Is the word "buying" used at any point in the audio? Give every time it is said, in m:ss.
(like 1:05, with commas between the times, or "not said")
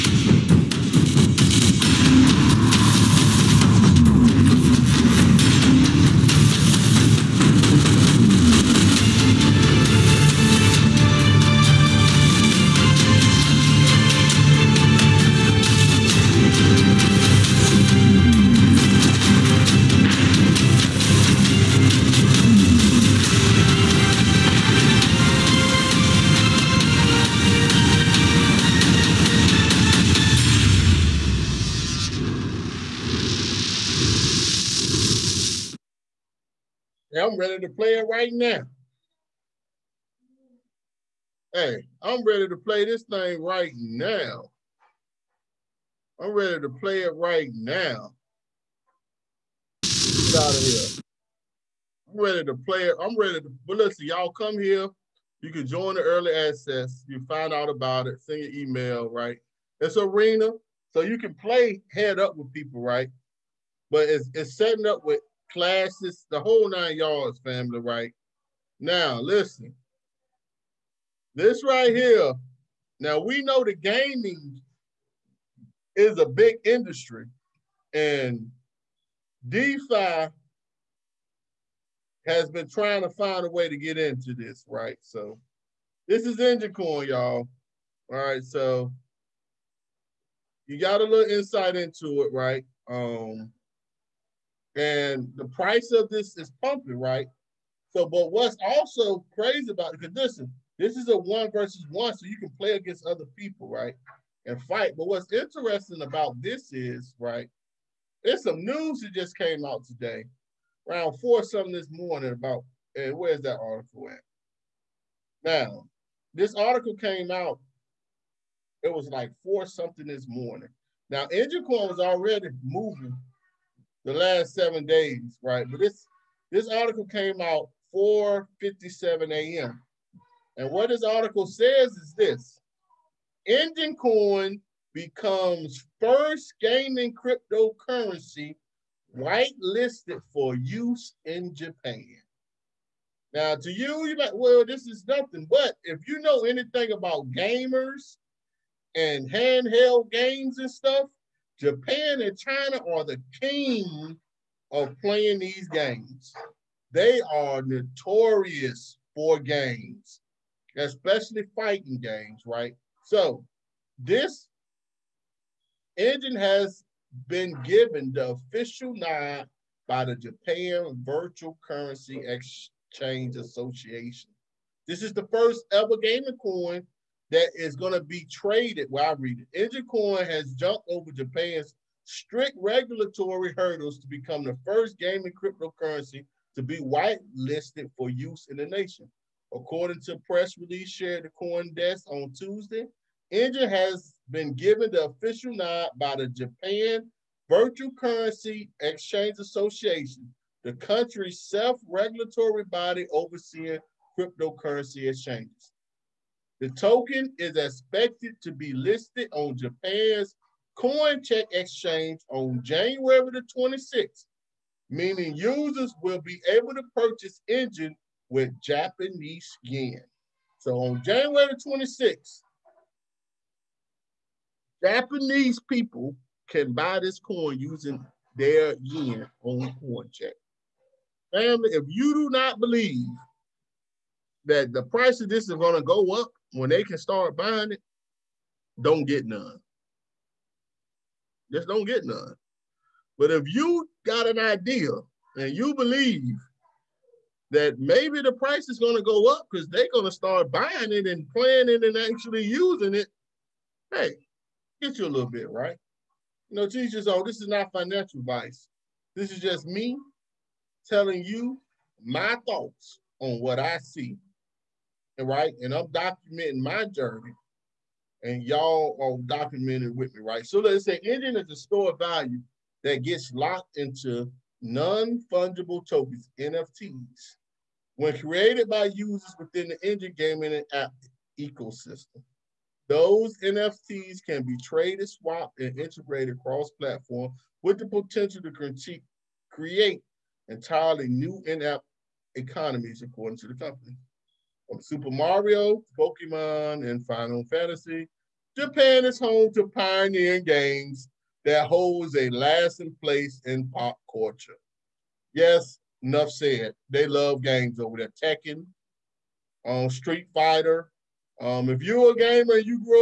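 3:57, 4:10.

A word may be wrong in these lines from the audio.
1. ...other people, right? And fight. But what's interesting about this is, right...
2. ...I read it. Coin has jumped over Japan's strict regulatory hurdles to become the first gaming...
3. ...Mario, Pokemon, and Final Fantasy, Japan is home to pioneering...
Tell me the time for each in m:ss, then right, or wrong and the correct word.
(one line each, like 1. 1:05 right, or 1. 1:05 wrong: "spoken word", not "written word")
1. 1:43 right
2. 2:59 right
3. 4:55 right.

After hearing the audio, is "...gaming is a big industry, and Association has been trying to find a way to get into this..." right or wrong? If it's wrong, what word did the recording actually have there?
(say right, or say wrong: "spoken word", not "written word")
wrong: "DeFi", not "Association".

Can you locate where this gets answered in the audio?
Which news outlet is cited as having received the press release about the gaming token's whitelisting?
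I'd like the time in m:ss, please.
3:11.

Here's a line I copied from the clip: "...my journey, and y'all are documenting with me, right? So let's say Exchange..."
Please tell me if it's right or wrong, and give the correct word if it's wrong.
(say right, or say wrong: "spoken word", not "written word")
wrong: "Enjin", not "Exchange".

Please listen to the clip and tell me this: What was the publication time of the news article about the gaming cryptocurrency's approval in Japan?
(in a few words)
4:57 a.m.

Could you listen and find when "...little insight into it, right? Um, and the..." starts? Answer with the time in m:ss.
1:31.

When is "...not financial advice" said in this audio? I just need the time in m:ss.
4:17.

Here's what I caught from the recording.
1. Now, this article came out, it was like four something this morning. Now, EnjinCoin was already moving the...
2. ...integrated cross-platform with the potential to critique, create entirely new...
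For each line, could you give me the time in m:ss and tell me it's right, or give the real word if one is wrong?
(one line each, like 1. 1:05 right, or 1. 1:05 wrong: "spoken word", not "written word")
1. 1:55 right
2. 4:45 right.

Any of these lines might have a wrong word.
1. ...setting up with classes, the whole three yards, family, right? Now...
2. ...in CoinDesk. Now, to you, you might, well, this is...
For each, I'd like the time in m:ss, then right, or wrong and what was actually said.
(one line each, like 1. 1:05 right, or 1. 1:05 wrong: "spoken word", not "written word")
1. 1:04 wrong: "nine", not "three"
2. 2:21 wrong: "Japan", not "CoinDesk".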